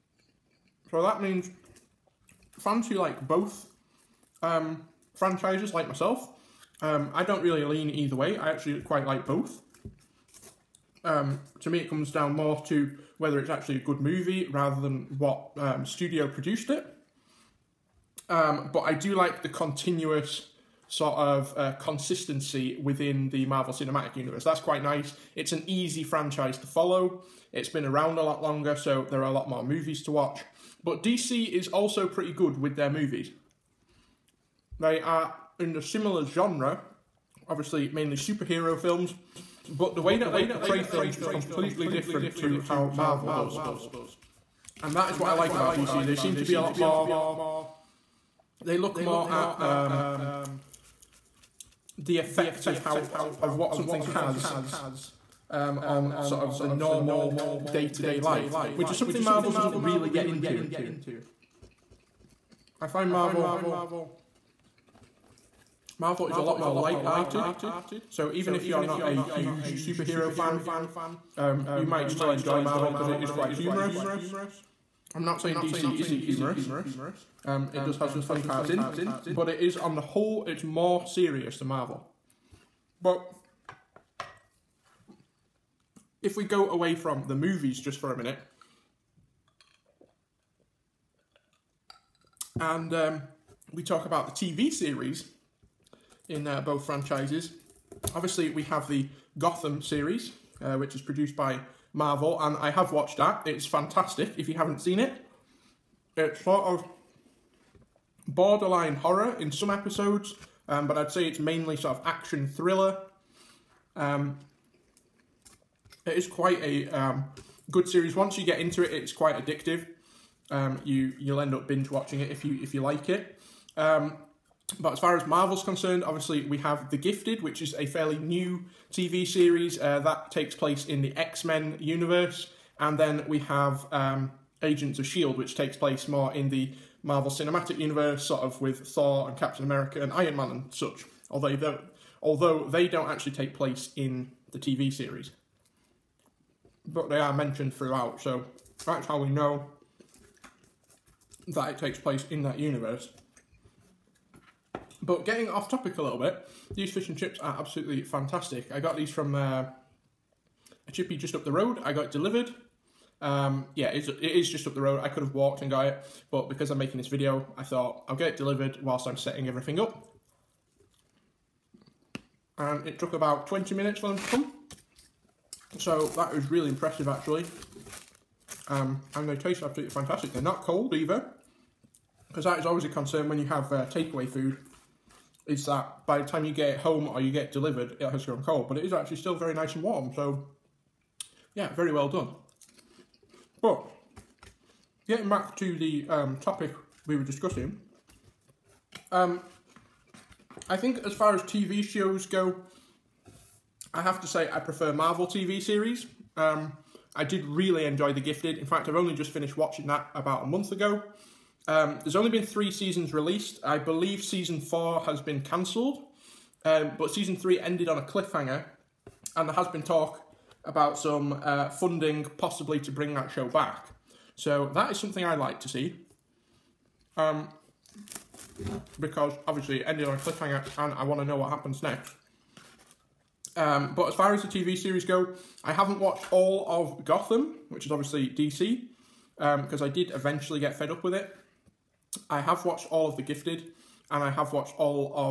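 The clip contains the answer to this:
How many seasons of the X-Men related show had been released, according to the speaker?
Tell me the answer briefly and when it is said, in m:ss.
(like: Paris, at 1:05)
3, at 3:32.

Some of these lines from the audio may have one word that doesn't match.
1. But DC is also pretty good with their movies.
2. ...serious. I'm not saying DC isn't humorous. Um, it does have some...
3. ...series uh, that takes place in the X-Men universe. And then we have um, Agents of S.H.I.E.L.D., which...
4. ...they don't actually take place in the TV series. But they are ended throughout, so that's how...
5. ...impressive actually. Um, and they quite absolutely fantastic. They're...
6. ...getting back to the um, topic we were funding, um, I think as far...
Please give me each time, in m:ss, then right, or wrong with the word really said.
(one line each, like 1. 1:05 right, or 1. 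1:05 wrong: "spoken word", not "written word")
1. 0:30 right
2. 1:13 wrong: "humorous", not "serious"
3. 2:09 right
4. 2:22 wrong: "mentioned", not "ended"
5. 2:56 wrong: "taste", not "quite"
6. 3:15 wrong: "discussing", not "funding".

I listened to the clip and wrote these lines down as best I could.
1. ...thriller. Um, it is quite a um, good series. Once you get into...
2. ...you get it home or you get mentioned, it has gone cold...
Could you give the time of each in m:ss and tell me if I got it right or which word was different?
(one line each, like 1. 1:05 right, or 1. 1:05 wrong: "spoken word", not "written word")
1. 1:52 right
2. 3:06 wrong: "delivered", not "mentioned".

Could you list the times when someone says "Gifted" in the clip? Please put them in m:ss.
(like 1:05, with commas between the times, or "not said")
2:06, 3:28, 4:03.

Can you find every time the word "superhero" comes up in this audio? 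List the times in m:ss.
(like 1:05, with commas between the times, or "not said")
0:38, 1:09.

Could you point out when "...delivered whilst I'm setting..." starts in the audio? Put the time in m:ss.
2:48.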